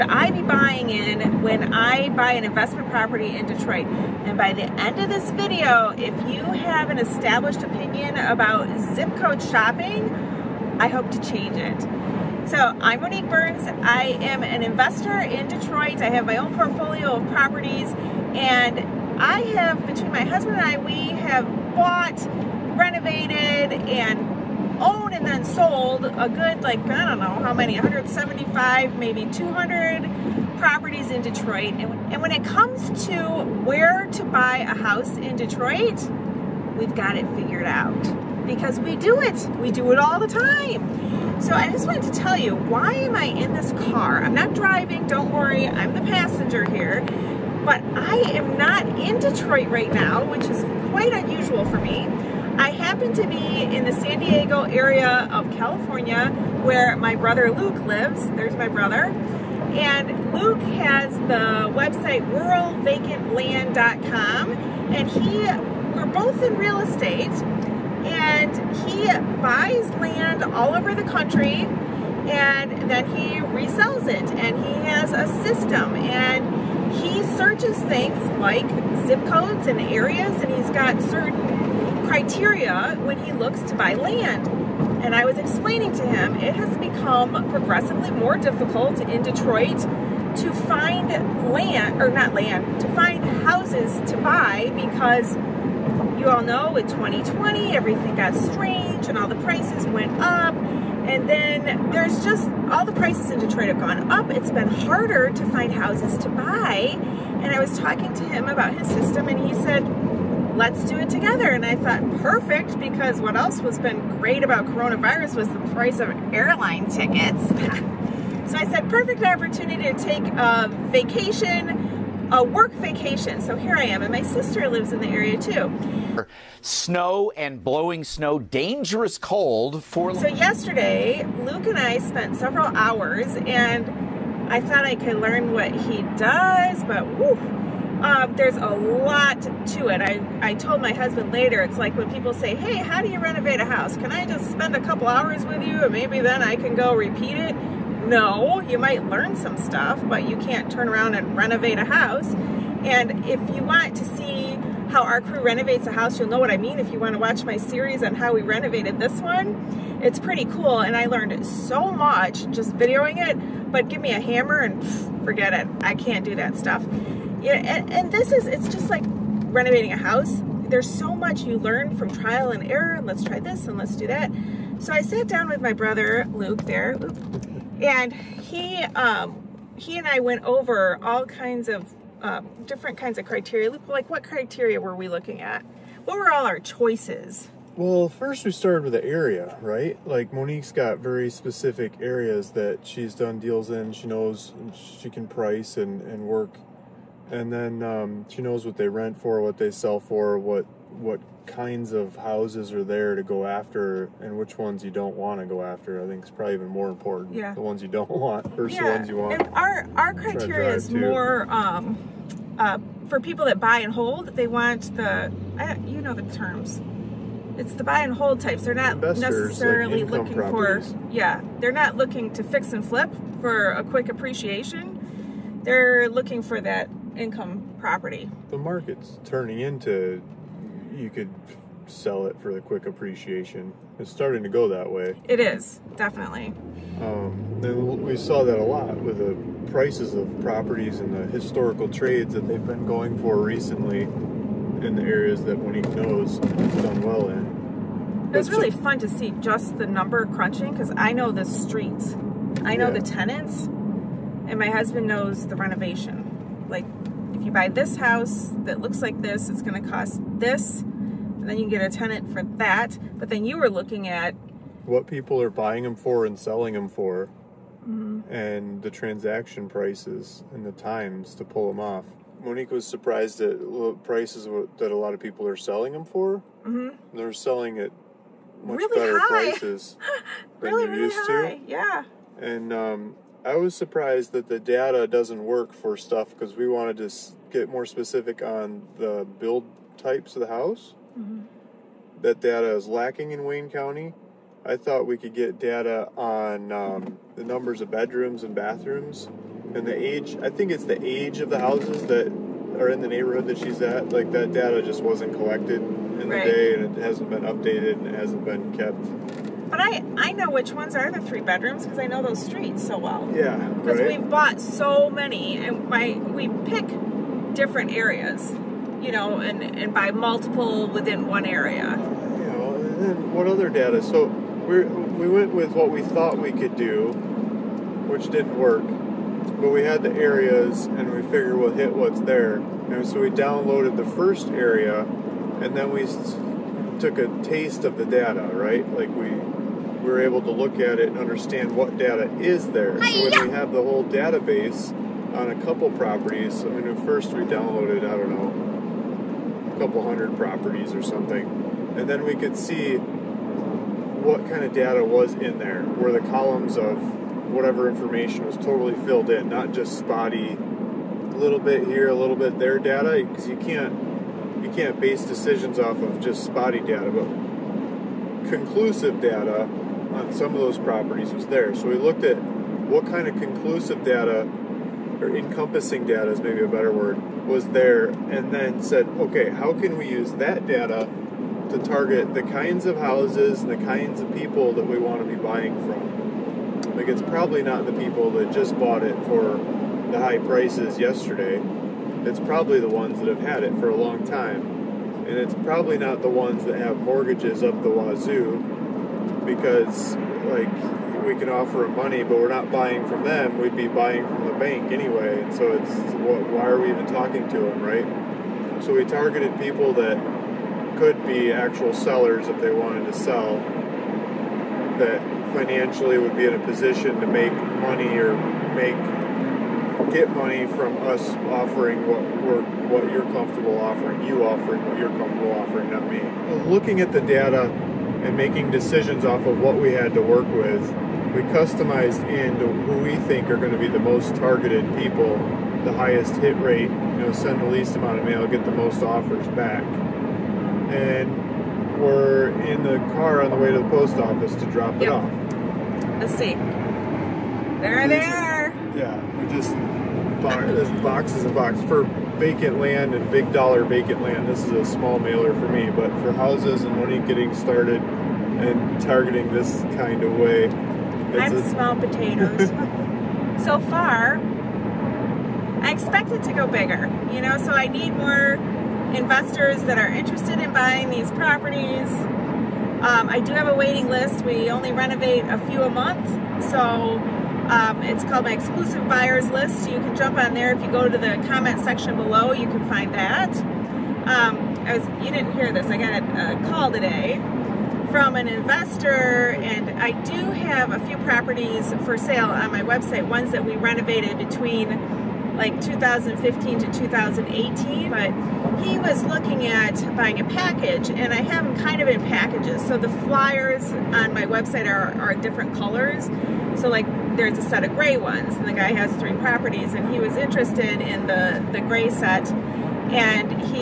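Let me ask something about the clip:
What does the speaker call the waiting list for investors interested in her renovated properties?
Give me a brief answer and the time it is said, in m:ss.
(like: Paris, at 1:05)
exclusive buyers list, at 7:58.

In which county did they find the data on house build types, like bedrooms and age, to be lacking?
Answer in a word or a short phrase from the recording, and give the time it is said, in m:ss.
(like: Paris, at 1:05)
Wayne County, at 4:53.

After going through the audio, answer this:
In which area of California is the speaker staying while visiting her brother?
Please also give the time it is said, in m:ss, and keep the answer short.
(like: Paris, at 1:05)
San Diego, at 0:53.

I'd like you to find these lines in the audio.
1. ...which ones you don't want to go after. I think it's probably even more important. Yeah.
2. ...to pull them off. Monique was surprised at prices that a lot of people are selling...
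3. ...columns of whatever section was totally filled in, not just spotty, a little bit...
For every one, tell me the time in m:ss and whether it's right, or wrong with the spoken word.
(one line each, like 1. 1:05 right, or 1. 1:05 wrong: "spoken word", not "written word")
1. 3:24 right
2. 4:31 right
3. 5:56 wrong: "information", not "section".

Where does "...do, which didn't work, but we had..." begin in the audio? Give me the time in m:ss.
5:26.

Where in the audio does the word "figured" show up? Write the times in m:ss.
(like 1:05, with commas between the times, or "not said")
0:37, 5:31.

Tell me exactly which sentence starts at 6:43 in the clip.
We'd be buying from the bank anyway.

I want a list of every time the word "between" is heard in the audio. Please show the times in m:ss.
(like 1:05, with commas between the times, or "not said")
0:19, 8:14.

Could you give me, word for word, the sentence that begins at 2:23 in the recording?
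Can I just spend a couple hours with you and maybe then I can go repeat it?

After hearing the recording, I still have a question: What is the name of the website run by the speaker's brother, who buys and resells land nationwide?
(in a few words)
ruralvacantland.com.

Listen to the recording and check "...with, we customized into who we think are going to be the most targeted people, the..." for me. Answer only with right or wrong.
right.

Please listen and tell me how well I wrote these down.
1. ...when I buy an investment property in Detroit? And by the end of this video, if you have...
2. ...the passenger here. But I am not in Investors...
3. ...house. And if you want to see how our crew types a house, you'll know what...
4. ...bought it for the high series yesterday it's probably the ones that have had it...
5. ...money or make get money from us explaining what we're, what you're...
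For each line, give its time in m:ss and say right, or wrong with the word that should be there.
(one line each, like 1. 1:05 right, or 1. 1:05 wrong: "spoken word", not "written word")
1. 0:01 right
2. 0:45 wrong: "Detroit", not "Investors"
3. 2:31 wrong: "renovates", not "types"
4. 6:28 wrong: "prices", not "series"
5. 6:57 wrong: "offering", not "explaining".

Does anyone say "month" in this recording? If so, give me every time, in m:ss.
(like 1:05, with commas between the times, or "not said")
7:55.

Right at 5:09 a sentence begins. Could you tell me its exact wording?
But I, I know which ones are the three bedrooms because I know those streets so well.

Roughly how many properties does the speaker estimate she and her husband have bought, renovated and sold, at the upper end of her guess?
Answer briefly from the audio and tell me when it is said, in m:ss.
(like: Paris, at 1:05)
200, at 0:29.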